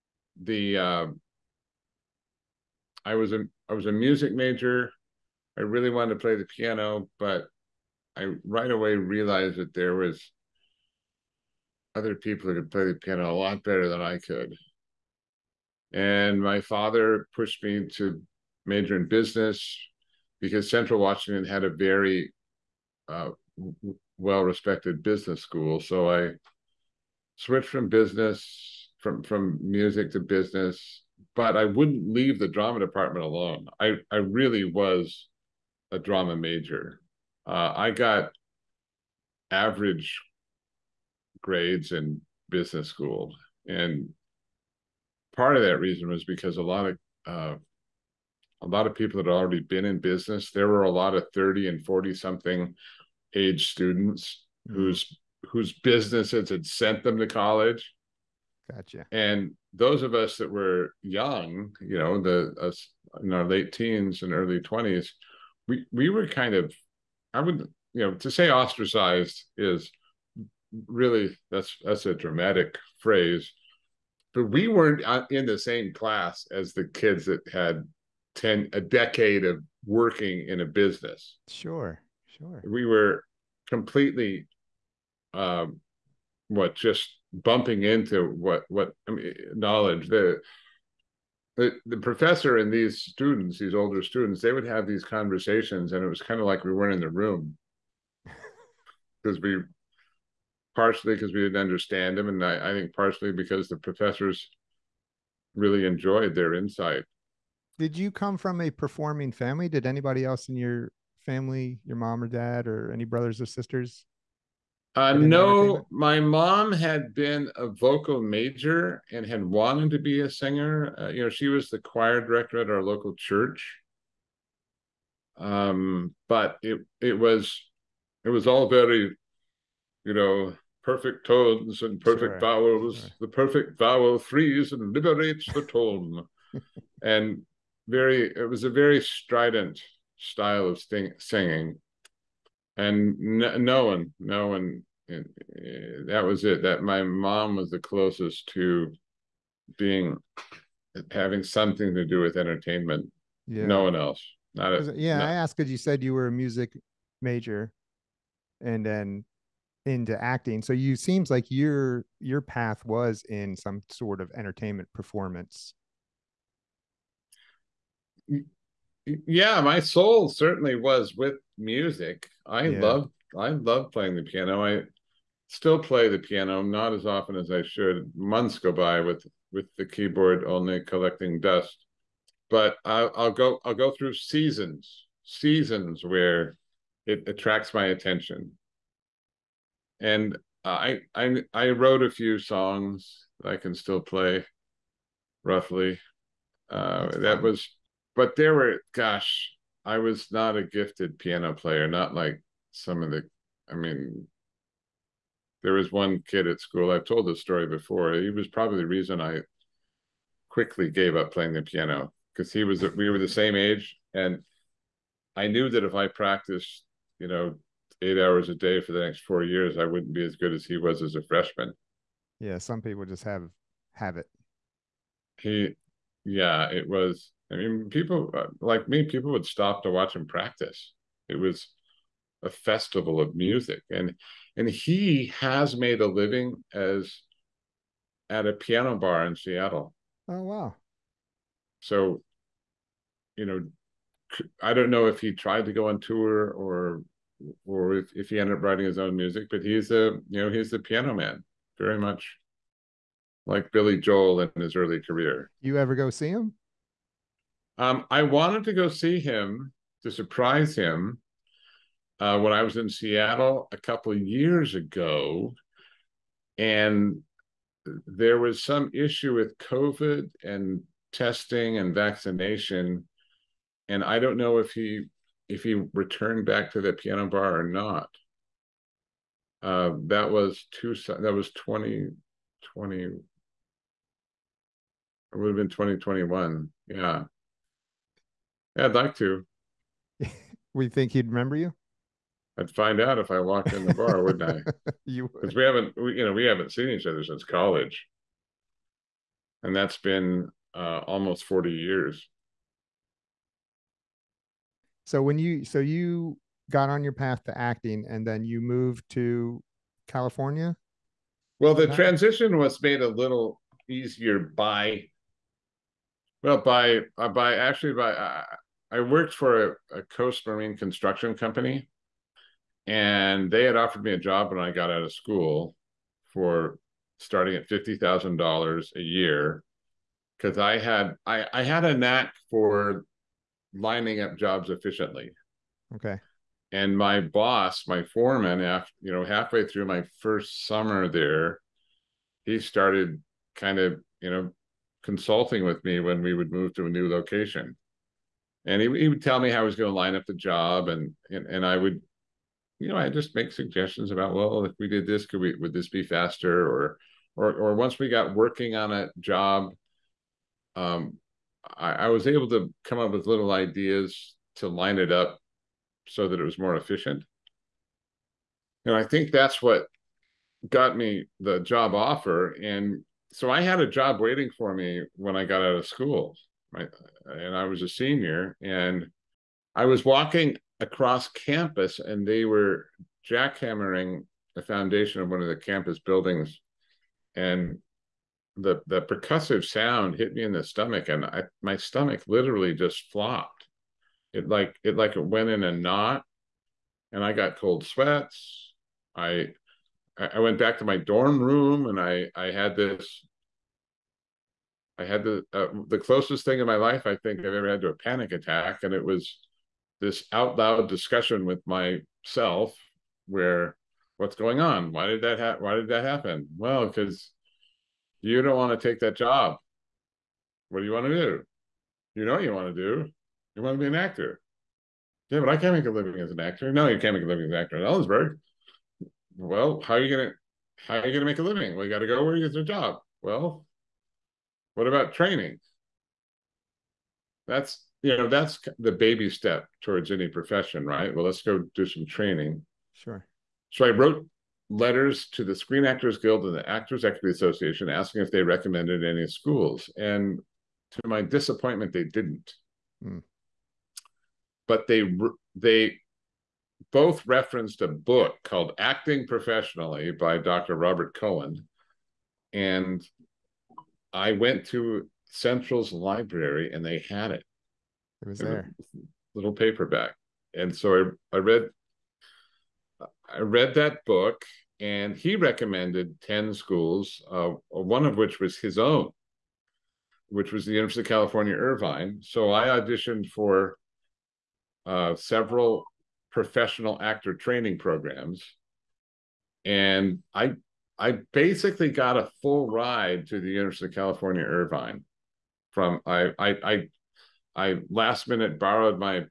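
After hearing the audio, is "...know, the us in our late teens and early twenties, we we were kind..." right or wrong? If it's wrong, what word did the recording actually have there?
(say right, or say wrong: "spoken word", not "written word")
right.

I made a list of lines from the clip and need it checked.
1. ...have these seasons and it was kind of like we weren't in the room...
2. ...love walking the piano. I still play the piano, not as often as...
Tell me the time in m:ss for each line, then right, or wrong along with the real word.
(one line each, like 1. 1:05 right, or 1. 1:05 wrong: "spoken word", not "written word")
1. 1:34 wrong: "conversations", not "seasons"
2. 2:53 wrong: "playing", not "walking".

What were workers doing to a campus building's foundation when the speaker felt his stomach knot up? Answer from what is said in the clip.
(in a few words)
Jackhammering.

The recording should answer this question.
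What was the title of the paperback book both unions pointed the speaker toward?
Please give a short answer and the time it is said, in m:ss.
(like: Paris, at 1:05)
Acting Professionally, at 7:38.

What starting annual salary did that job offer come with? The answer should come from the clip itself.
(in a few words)
$50,000.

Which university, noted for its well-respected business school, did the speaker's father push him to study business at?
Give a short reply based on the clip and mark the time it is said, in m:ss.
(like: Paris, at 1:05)
Central Washington, at 0:20.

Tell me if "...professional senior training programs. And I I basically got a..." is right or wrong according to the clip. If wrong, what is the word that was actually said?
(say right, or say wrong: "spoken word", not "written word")
wrong: "actor", not "senior".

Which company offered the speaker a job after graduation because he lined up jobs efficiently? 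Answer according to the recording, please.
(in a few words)
Coast Marine construction company.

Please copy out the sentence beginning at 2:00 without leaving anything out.
Uh, you know, she was the choir director at our local church.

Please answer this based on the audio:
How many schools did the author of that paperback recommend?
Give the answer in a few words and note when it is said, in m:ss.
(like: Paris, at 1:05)
10, at 7:56.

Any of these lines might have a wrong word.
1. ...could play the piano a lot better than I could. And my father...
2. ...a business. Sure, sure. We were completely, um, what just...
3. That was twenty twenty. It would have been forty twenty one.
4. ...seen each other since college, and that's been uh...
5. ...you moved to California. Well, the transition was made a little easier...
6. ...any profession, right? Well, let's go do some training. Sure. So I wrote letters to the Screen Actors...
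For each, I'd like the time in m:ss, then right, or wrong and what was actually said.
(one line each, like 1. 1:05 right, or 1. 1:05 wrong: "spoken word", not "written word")
1. 0:12 right
2. 1:20 right
3. 4:41 wrong: "twenty", not "forty"
4. 4:56 right
5. 5:08 right
6. 7:20 right.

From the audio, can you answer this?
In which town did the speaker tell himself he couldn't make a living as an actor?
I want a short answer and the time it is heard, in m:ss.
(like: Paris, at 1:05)
Ellensburg, at 7:07.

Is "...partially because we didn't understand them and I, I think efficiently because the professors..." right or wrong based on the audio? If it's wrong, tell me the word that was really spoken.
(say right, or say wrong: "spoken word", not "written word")
wrong: "partially", not "efficiently".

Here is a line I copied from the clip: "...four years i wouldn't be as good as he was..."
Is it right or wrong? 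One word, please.
right.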